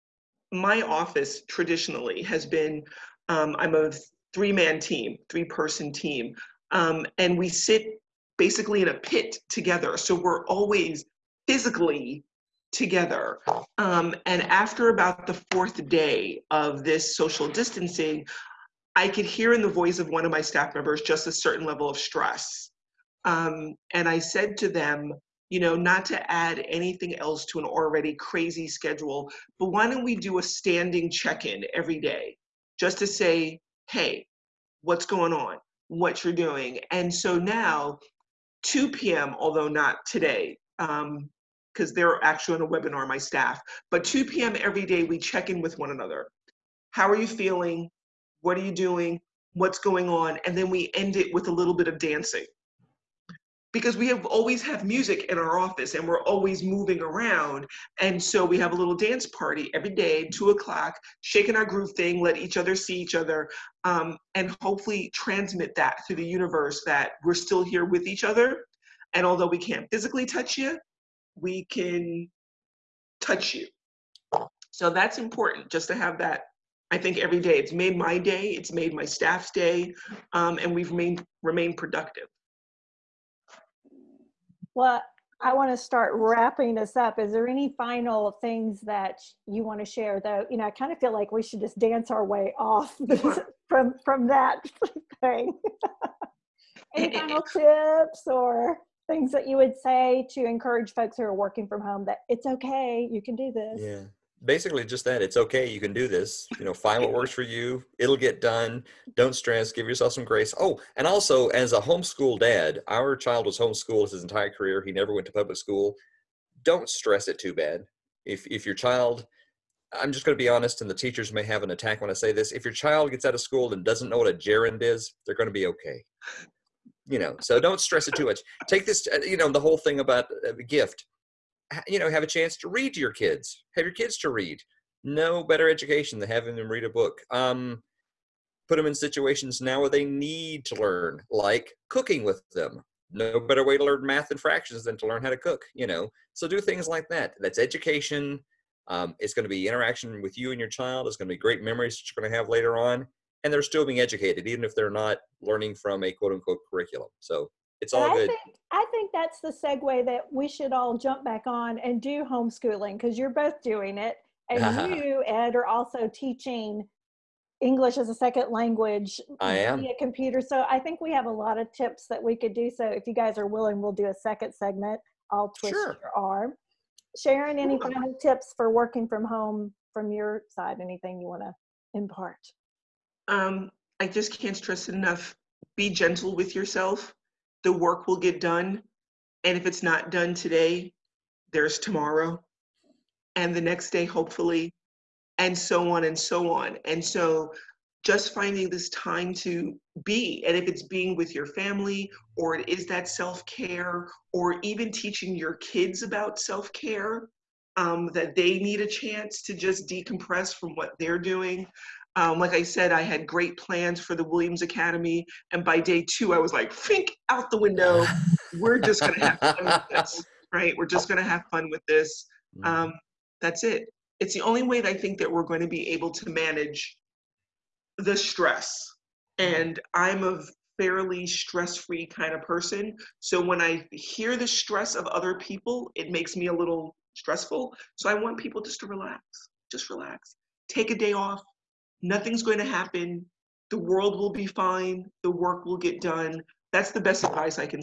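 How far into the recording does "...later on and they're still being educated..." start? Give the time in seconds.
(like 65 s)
152 s.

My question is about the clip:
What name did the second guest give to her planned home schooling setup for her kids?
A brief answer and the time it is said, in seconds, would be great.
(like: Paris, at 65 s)
Williams Academy, at 214 s.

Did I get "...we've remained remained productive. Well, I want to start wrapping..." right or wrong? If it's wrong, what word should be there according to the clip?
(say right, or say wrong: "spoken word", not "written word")
right.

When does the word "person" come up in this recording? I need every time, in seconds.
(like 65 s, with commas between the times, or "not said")
5 s, 232 s.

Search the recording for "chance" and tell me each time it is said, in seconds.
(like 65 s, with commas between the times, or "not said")
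132 s, 208 s.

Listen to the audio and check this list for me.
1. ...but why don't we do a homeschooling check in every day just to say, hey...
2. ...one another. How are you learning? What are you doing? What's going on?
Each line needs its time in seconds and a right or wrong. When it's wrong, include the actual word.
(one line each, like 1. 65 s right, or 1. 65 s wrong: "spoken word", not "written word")
1. 29 s wrong: "standing", not "homeschooling"
2. 45 s wrong: "feeling", not "learning".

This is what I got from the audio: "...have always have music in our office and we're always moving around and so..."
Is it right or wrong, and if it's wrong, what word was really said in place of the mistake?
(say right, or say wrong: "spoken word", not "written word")
right.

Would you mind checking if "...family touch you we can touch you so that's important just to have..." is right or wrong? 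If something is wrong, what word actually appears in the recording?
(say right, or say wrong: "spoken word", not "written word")
wrong: "physically", not "family".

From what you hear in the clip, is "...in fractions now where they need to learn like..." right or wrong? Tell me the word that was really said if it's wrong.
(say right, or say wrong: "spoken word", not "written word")
wrong: "situations", not "fractions".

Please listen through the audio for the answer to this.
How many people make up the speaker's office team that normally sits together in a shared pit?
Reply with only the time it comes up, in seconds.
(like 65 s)
5 s.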